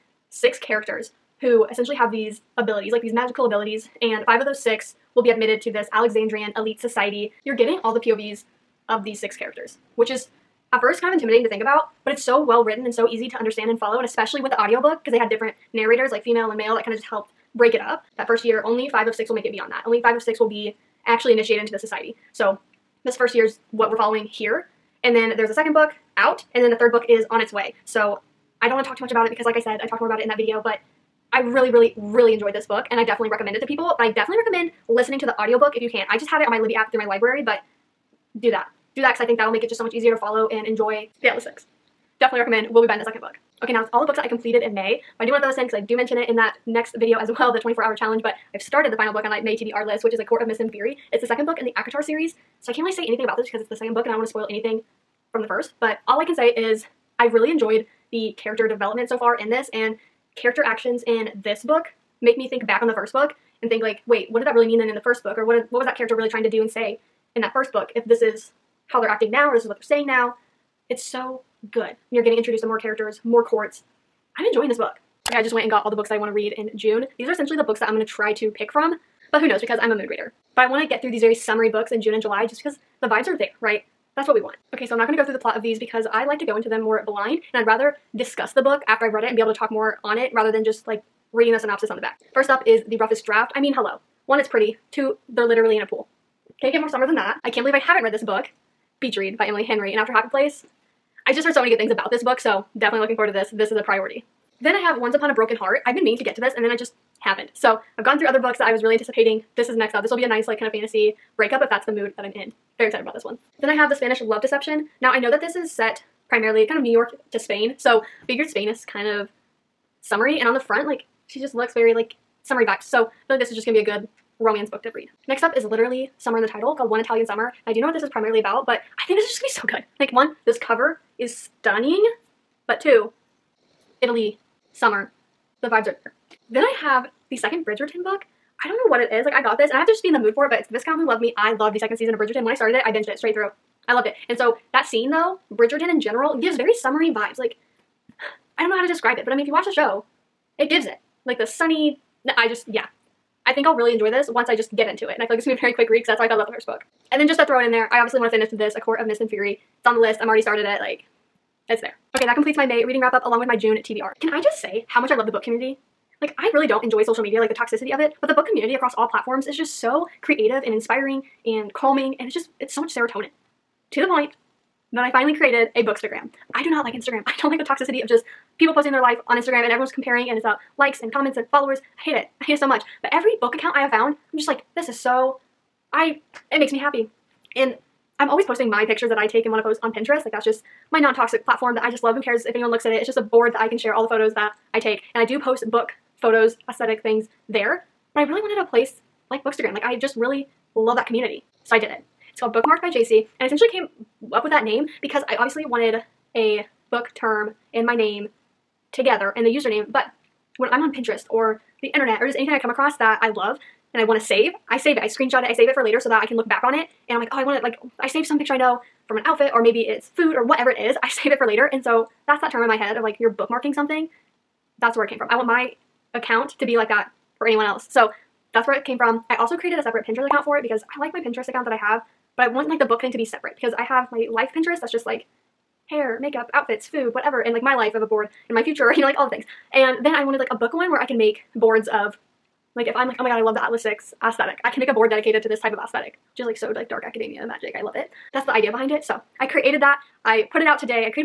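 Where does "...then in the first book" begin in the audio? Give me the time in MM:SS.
01:04.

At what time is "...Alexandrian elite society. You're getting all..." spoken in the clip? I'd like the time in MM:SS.
00:05.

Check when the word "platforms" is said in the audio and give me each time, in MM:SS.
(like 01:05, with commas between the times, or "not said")
02:49, 03:11.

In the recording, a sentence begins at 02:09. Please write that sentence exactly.
Like one, this cover is stunning, but two, Italy, summer, the vibes are there.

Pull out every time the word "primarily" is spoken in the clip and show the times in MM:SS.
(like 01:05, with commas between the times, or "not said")
01:56, 02:08.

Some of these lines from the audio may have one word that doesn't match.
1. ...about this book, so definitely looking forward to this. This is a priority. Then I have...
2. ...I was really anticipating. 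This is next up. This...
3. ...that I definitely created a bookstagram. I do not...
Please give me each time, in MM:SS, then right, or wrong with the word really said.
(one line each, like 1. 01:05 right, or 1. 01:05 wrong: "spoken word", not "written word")
1. 01:41 right
2. 01:48 right
3. 02:54 wrong: "finally", not "definitely".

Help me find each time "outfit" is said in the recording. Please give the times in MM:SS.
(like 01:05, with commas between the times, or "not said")
03:39, 03:56.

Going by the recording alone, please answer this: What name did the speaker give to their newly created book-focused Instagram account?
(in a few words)
Bookmarked by Jaycie.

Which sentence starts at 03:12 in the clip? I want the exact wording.
Who cares if anyone looks at it?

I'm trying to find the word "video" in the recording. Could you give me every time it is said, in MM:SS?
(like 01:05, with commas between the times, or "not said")
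00:30, 00:46.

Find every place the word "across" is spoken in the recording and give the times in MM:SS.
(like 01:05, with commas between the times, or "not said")
02:48, 03:32.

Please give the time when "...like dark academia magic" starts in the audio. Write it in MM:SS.
04:06.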